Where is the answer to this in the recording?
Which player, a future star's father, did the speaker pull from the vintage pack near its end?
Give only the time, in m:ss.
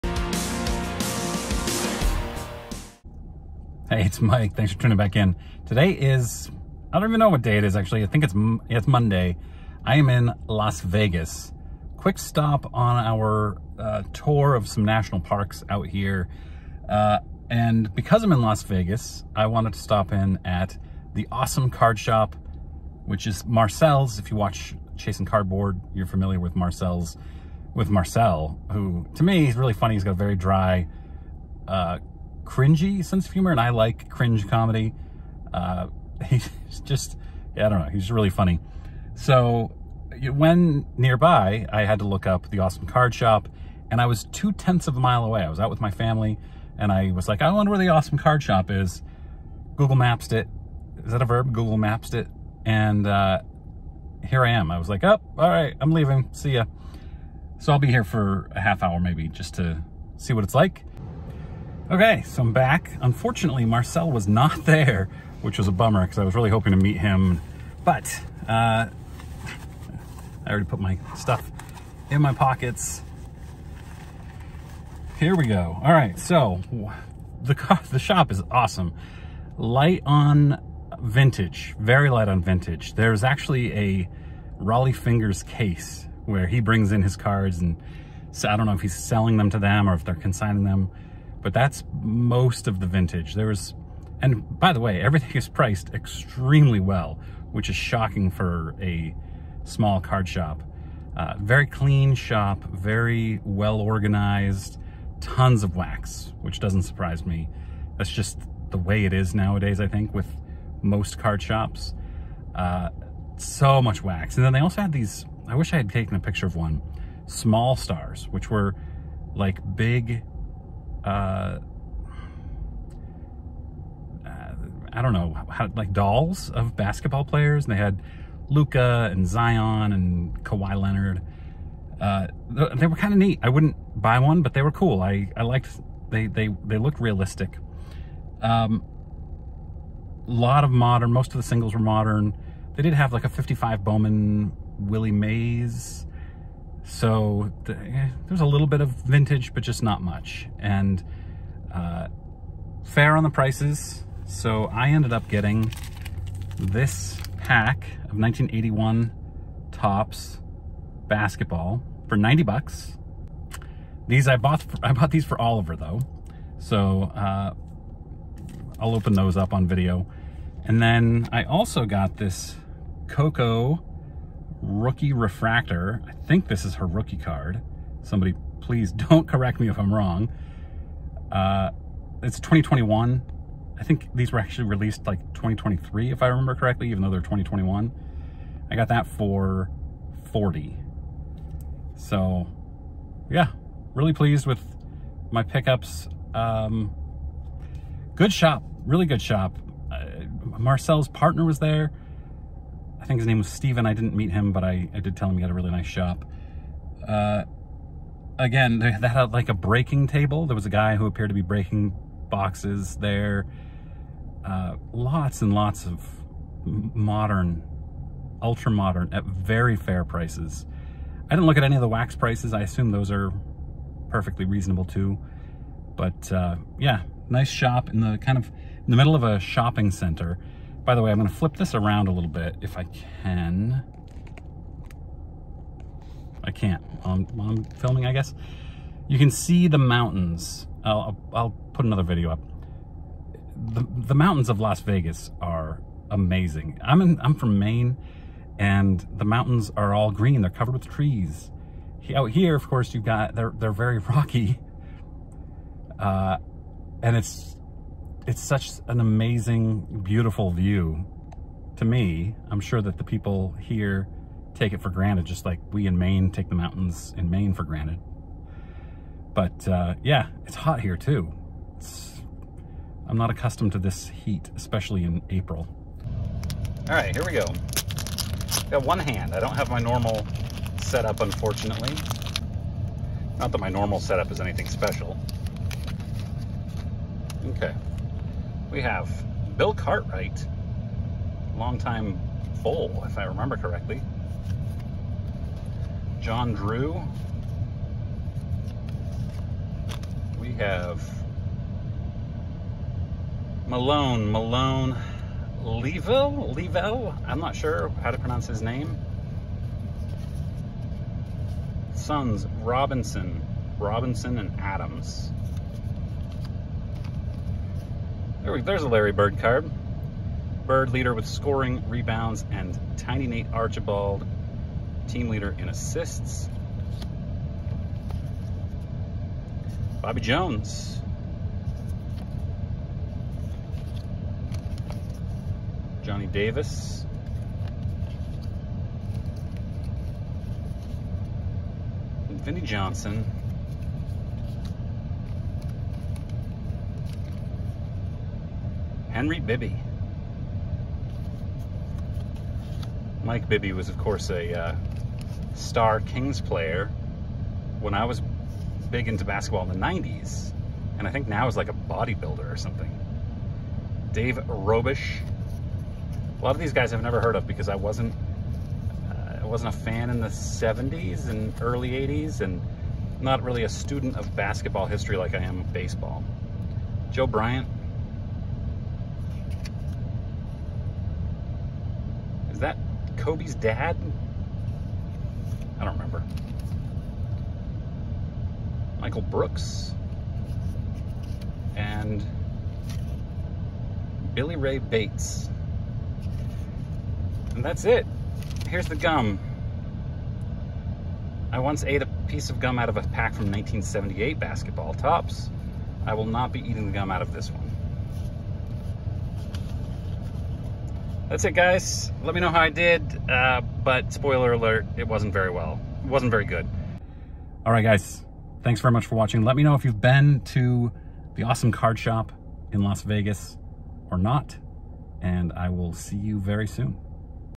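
6:17.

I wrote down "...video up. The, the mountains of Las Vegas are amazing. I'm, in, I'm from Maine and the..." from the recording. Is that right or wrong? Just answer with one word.
right.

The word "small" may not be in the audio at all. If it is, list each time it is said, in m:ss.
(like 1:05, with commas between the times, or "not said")
1:39, 1:57.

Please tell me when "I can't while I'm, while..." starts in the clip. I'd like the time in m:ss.
3:56.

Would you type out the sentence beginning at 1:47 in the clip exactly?
That's just the way it is nowadays, I think, with most card shops.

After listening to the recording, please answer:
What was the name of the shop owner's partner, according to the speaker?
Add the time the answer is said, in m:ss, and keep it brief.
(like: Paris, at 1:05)
Steven, at 3:23.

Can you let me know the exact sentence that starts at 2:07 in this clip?
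And they had Luka and Zion and Kawhi Leonard.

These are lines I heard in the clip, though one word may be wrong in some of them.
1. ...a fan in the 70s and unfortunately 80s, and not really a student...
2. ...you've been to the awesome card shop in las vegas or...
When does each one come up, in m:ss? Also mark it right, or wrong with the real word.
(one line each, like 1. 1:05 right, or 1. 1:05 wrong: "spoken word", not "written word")
1. 6:09 wrong: "early", not "unfortunately"
2. 6:59 right.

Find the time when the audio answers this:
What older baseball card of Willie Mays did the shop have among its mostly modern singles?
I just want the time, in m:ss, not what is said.
2:23.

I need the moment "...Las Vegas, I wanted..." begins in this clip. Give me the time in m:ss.
0:18.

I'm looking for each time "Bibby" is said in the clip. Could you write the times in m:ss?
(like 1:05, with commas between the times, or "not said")
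5:49, 5:53.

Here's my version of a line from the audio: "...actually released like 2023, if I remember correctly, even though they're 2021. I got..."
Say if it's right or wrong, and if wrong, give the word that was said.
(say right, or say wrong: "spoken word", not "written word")
right.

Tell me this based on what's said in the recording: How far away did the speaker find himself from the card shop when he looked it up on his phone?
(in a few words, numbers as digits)
two tenths of a mile.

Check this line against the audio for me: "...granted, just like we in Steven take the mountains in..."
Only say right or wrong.
wrong.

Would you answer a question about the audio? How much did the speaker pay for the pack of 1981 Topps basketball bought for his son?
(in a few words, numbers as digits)
$90.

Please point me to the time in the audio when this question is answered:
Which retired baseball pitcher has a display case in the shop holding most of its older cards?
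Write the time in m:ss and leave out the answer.
1:24.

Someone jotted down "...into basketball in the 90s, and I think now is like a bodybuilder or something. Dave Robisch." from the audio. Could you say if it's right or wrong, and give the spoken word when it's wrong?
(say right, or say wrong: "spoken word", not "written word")
right.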